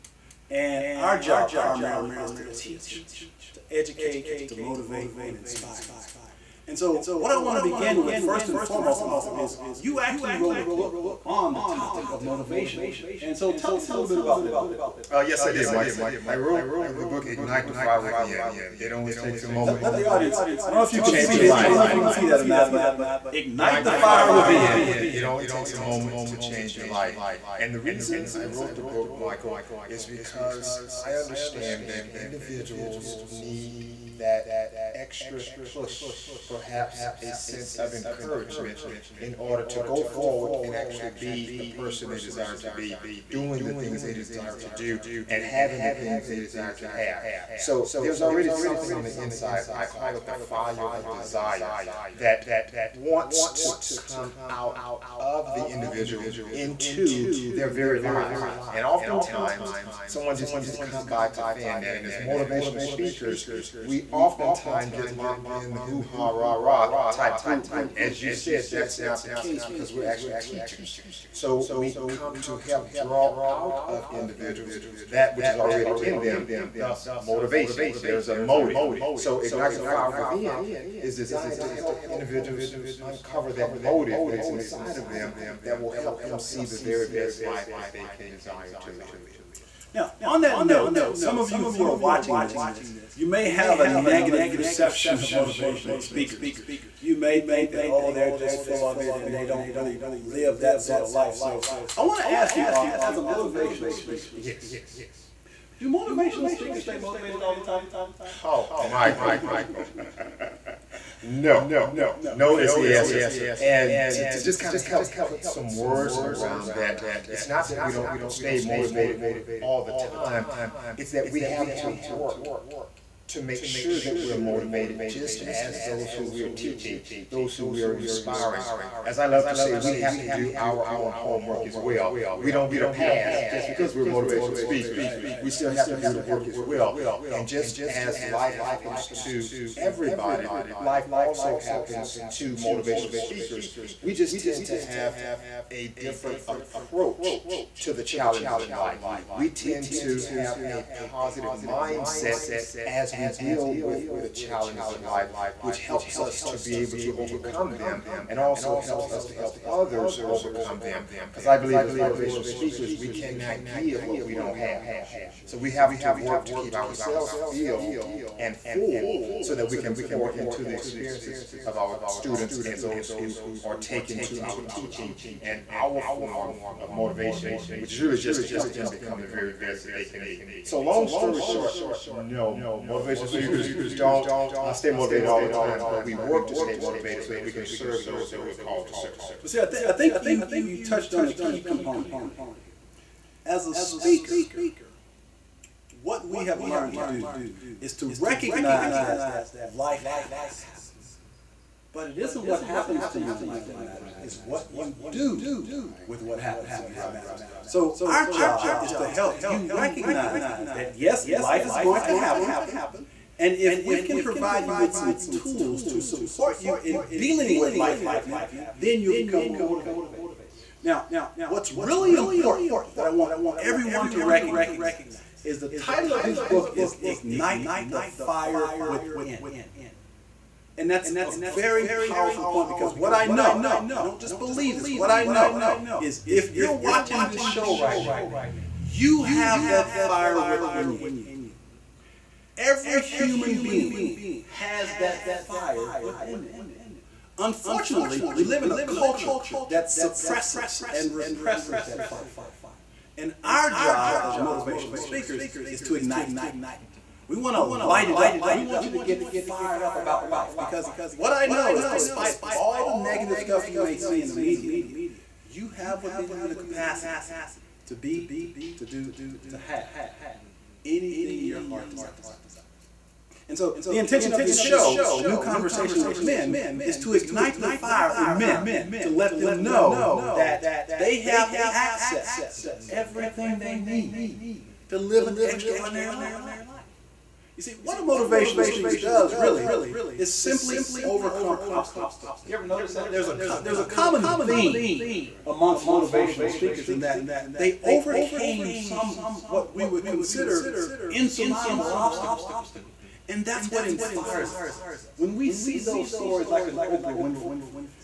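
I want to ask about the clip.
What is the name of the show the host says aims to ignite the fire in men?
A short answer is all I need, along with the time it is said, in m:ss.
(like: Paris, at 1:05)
A New Conversation with Men, at 4:35.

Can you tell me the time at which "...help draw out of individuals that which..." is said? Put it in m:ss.
1:12.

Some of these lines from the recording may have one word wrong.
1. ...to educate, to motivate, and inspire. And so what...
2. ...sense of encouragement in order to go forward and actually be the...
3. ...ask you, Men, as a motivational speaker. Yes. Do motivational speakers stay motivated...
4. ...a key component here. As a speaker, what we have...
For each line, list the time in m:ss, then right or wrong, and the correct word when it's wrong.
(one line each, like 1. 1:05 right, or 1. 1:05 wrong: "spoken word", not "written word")
1. 0:03 right
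2. 0:37 right
3. 1:42 wrong: "Arthur", not "Men"
4. 3:11 right.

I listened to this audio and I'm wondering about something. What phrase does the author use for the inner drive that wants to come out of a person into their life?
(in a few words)
the fire of desire.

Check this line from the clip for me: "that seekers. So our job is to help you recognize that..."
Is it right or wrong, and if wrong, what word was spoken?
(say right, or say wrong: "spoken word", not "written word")
wrong: "matters", not "seekers".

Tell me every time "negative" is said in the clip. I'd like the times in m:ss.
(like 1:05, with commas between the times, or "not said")
1:33, 4:22.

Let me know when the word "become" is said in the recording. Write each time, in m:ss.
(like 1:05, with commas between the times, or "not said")
2:58, 3:39.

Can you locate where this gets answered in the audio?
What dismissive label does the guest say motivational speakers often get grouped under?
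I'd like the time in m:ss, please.
1:05.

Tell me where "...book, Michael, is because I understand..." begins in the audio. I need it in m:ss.
0:28.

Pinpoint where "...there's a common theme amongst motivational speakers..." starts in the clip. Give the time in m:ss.
4:53.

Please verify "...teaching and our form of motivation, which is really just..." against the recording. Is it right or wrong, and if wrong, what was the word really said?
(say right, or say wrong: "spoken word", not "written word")
right.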